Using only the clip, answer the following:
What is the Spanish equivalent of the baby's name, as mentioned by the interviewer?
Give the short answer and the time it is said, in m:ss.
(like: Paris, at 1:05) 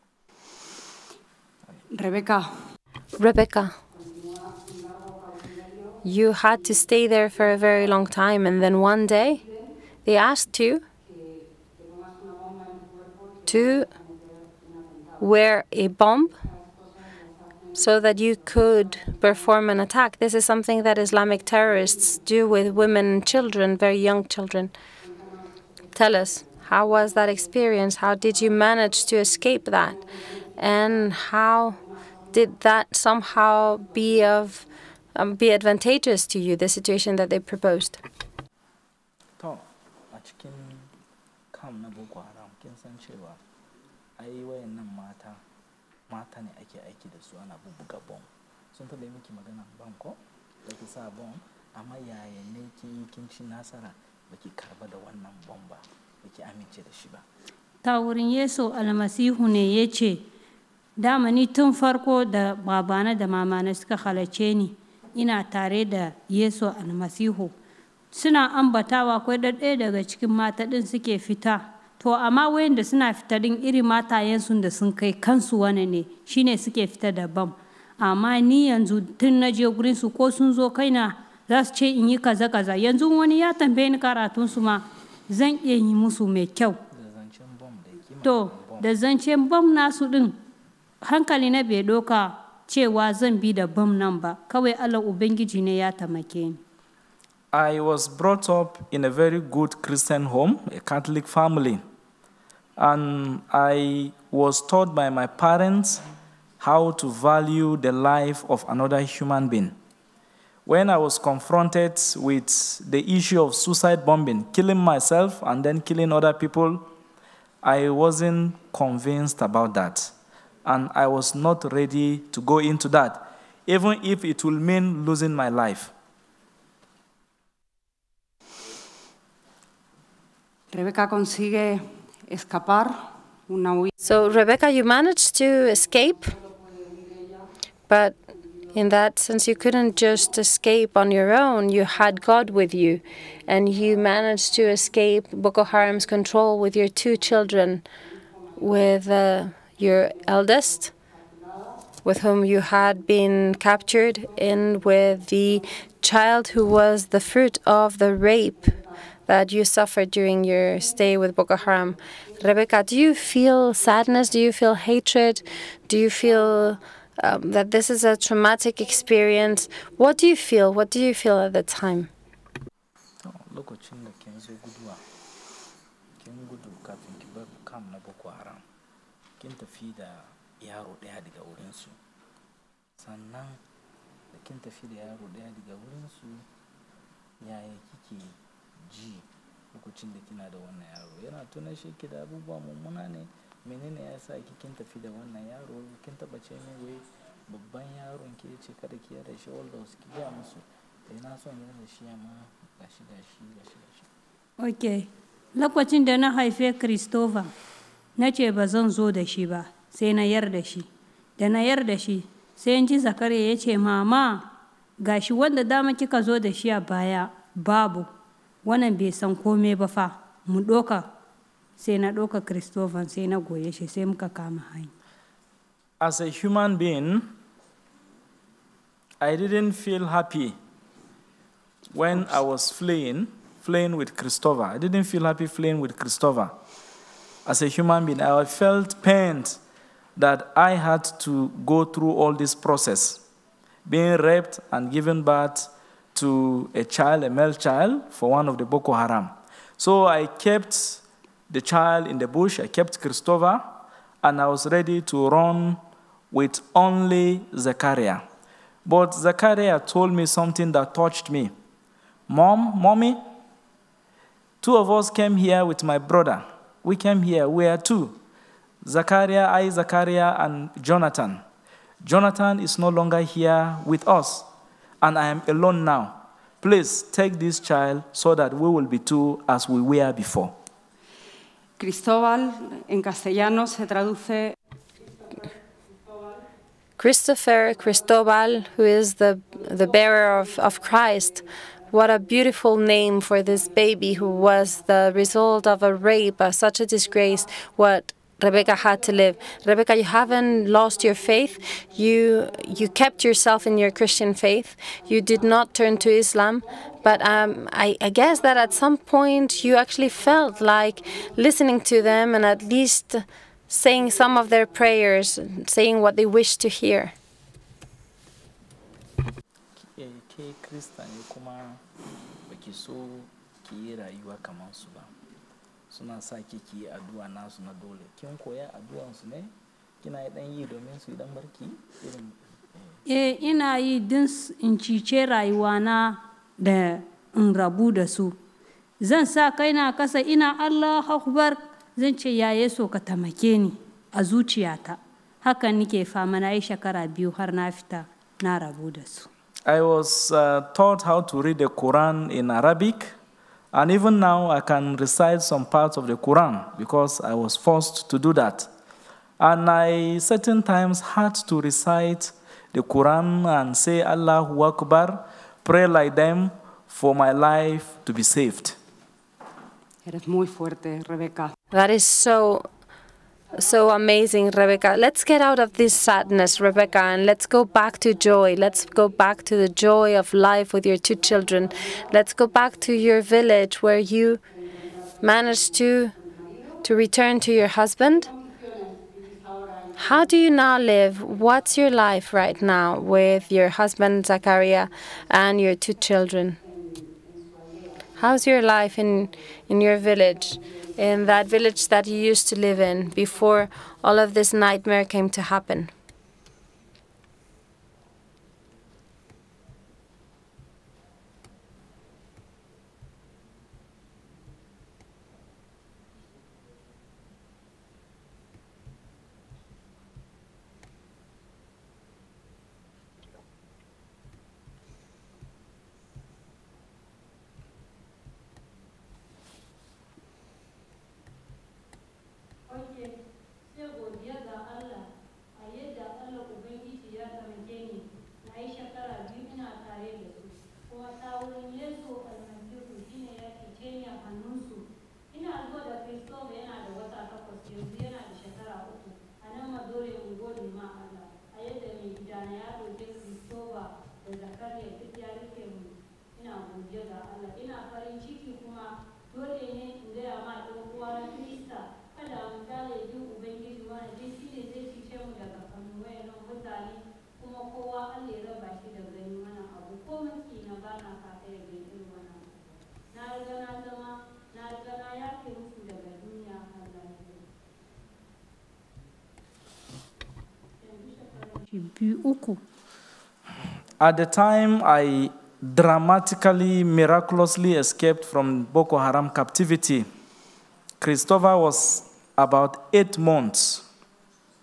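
Cristóbal, at 4:41.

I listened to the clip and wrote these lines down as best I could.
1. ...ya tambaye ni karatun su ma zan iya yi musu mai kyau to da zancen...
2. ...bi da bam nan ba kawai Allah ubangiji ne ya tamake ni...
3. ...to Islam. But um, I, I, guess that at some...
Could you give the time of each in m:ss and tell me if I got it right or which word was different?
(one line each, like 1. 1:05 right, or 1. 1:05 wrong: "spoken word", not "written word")
1. 1:23 right
2. 1:33 right
3. 5:05 right.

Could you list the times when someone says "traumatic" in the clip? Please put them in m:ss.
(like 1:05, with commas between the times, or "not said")
2:48.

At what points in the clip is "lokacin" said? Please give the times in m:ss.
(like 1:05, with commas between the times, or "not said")
3:09, 3:25.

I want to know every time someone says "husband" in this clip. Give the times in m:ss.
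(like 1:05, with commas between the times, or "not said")
6:27, 6:33.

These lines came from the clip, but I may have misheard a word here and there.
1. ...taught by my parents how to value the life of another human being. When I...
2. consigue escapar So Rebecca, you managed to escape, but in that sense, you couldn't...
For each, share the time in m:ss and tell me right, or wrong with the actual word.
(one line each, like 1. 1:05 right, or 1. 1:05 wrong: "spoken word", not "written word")
1. 1:44 right
2. 2:10 right.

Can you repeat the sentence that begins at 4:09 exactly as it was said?
So I kept the child in the bush, I kept Christopher, and I was ready to run with only Zachariah.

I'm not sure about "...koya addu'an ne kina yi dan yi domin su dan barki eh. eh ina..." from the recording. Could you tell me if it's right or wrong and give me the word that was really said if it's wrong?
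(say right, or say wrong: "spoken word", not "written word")
right.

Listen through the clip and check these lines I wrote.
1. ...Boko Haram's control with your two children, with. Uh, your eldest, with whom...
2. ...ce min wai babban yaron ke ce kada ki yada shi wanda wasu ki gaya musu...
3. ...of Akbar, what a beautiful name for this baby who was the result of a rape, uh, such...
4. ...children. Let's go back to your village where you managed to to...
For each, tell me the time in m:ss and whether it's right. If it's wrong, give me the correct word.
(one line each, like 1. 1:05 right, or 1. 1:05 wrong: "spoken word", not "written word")
1. 2:25 right
2. 3:16 right
3. 4:50 wrong: "Christ", not "Akbar"
4. 6:21 right.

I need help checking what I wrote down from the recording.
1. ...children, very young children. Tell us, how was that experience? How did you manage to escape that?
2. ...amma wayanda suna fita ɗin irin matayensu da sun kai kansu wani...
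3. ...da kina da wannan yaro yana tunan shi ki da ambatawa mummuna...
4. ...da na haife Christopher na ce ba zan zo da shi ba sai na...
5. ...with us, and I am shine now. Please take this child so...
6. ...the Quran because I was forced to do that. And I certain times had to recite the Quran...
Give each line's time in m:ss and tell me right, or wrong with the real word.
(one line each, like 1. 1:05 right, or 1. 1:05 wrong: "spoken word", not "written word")
1. 0:23 right
2. 1:12 right
3. 3:10 wrong: "abubuwa", not "ambatawa"
4. 3:26 right
5. 4:33 wrong: "alone", not "shine"
6. 5:56 right.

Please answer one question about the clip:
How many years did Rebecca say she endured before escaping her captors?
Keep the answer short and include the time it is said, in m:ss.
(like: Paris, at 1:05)
2, at 5:46.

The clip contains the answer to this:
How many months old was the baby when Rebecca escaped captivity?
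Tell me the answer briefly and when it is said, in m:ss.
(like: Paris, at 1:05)
8, at 8:12.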